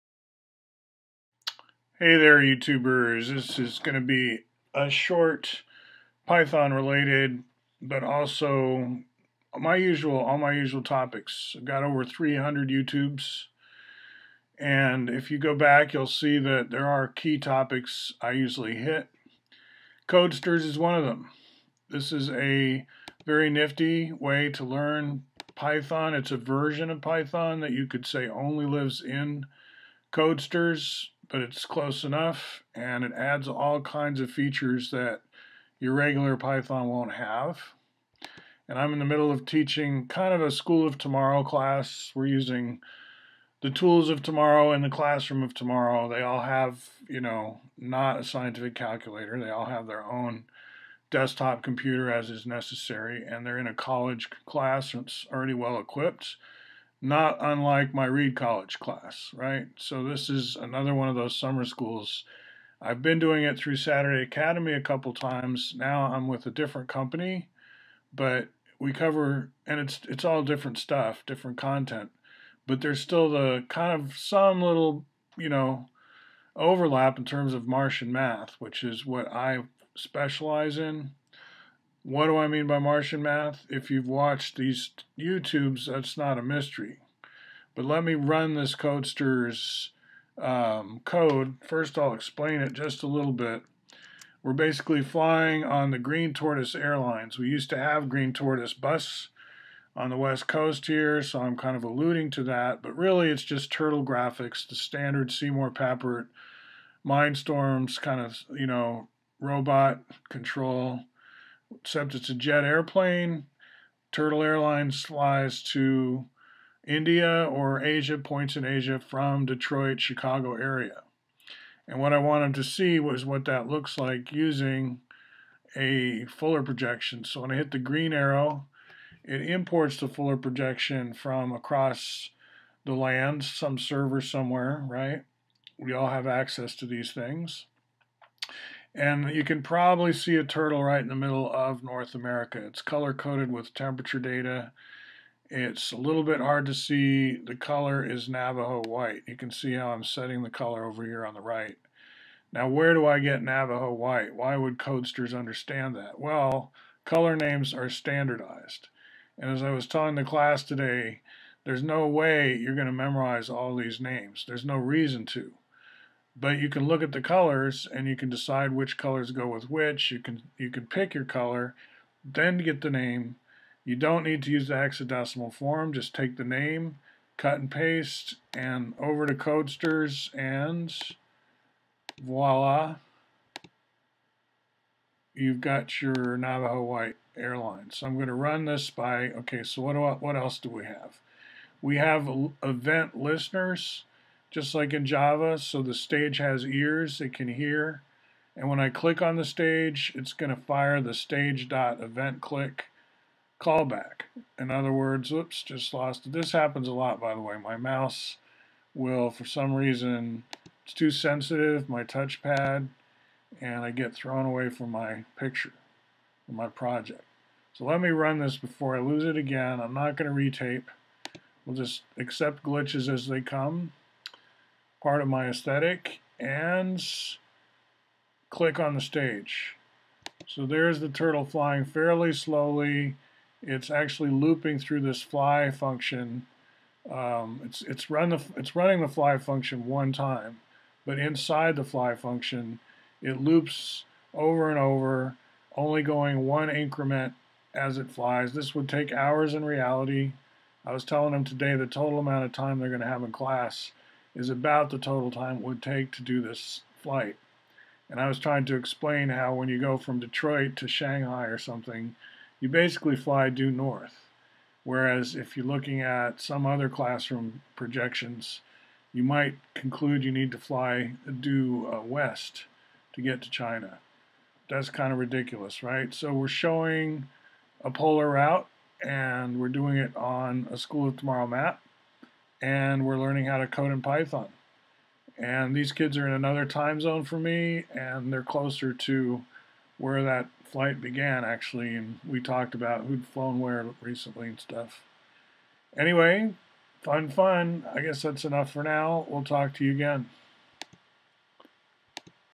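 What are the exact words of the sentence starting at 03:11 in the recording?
We have event listeners just like in Java.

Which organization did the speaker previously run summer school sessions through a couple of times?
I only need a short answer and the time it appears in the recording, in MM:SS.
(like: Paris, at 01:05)
Saturday Academy, at 01:03.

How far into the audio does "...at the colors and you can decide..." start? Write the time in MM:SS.
02:47.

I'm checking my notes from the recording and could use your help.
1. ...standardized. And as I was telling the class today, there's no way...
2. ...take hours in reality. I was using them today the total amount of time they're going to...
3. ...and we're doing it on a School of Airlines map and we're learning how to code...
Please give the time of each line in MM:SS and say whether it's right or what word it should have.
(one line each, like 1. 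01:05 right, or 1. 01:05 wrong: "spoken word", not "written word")
1. 02:37 right
2. 04:08 wrong: "telling", not "using"
3. 04:39 wrong: "Tomorrow", not "Airlines".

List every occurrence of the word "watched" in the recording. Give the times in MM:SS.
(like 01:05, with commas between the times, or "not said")
01:24.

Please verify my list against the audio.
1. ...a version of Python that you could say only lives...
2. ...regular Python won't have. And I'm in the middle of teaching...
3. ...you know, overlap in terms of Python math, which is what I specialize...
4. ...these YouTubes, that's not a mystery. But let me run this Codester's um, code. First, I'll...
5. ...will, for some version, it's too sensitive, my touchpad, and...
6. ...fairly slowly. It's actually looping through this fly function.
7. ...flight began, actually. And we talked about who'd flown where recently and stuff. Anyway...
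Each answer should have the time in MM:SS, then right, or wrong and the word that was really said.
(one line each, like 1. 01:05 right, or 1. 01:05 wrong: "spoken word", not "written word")
1. 00:26 right
2. 00:35 right
3. 01:15 wrong: "Martian", not "Python"
4. 01:24 right
5. 03:28 wrong: "reason", not "version"
6. 03:51 right
7. 04:50 right.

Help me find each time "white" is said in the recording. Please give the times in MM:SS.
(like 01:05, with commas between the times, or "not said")
02:28, 02:33, 03:06.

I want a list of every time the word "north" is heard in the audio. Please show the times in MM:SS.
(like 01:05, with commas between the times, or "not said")
02:21, 04:23.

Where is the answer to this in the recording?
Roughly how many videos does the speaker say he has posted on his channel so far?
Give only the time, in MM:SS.
00:11.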